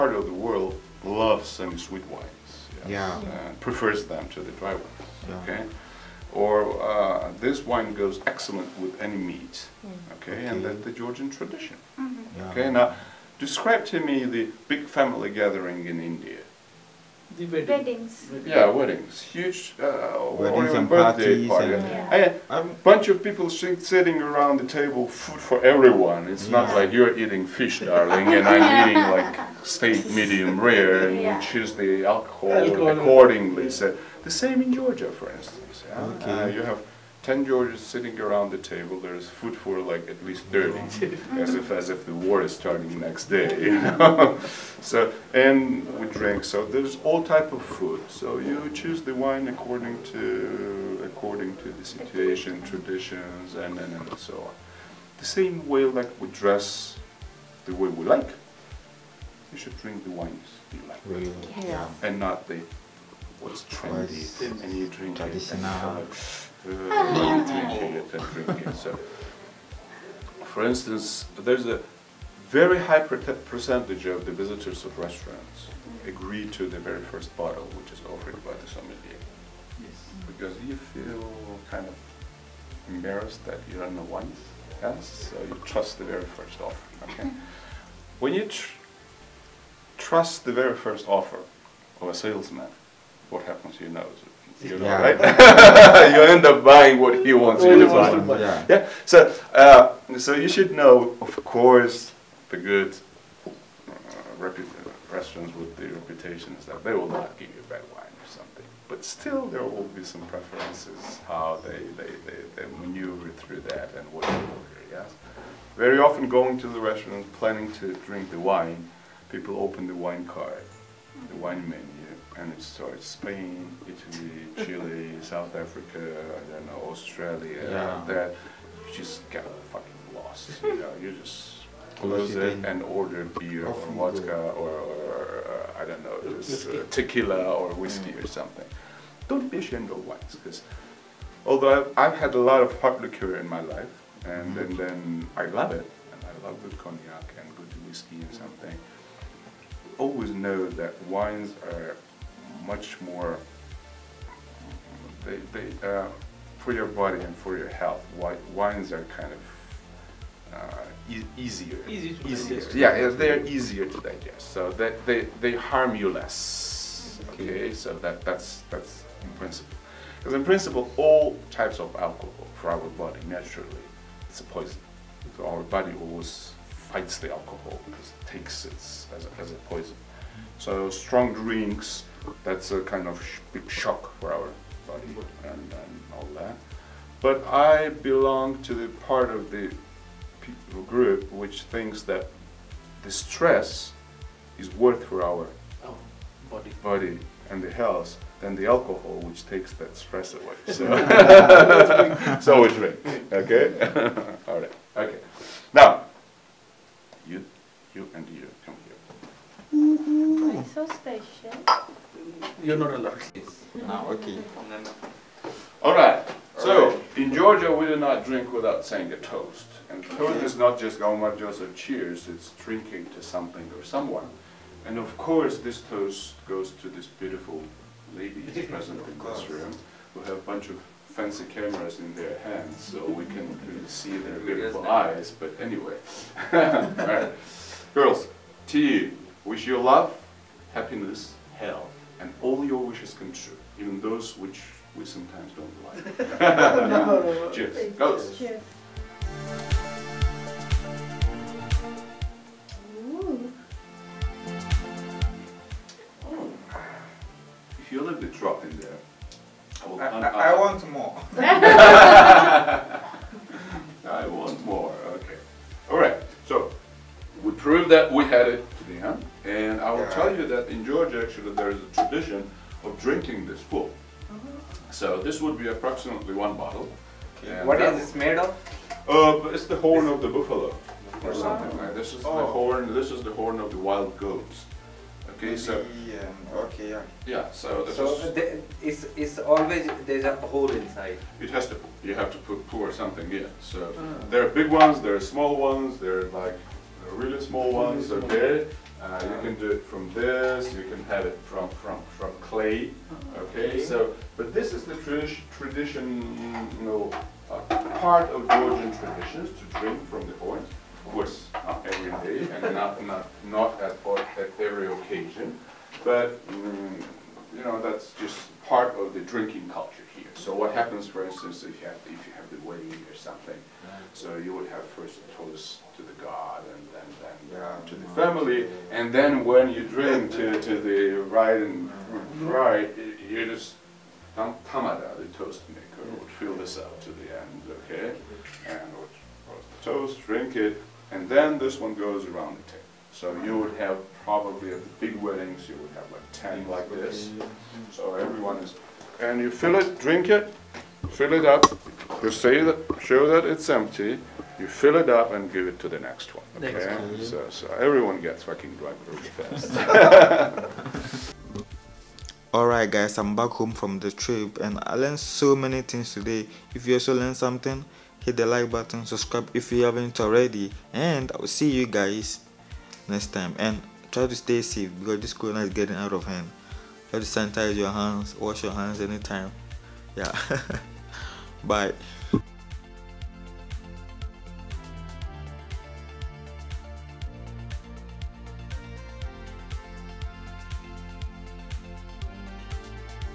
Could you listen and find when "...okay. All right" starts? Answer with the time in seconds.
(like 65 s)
214 s.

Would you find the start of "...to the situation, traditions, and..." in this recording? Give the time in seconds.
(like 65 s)
51 s.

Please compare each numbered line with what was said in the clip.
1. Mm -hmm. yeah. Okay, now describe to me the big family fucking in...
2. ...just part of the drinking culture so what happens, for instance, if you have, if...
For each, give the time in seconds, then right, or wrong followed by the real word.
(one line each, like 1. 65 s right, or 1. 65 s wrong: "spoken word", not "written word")
1. 11 s wrong: "gathering", not "fucking"
2. 318 s right.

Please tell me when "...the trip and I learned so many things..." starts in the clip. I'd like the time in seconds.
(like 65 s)
363 s.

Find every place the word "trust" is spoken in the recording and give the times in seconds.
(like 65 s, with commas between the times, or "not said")
85 s, 89 s.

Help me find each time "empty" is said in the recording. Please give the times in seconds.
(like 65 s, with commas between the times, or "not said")
353 s.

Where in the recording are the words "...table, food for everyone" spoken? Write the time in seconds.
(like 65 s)
24 s.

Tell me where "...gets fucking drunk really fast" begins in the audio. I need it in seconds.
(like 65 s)
358 s.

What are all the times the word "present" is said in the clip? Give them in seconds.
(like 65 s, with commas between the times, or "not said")
228 s.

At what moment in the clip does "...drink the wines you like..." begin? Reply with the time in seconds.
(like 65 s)
59 s.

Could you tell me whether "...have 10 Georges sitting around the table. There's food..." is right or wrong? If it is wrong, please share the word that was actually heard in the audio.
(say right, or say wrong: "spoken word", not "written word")
right.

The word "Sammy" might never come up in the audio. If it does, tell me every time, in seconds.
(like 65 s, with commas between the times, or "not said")
not said.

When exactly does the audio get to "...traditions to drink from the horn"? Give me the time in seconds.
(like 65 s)
308 s.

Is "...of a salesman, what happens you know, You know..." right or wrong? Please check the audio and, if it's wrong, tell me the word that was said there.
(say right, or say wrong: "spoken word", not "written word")
right.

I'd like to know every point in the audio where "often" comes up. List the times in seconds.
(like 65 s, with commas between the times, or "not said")
115 s.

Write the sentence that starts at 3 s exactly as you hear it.
And prefers them to the dry ones.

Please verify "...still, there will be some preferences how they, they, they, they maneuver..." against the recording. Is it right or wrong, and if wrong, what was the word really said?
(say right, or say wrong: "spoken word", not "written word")
right.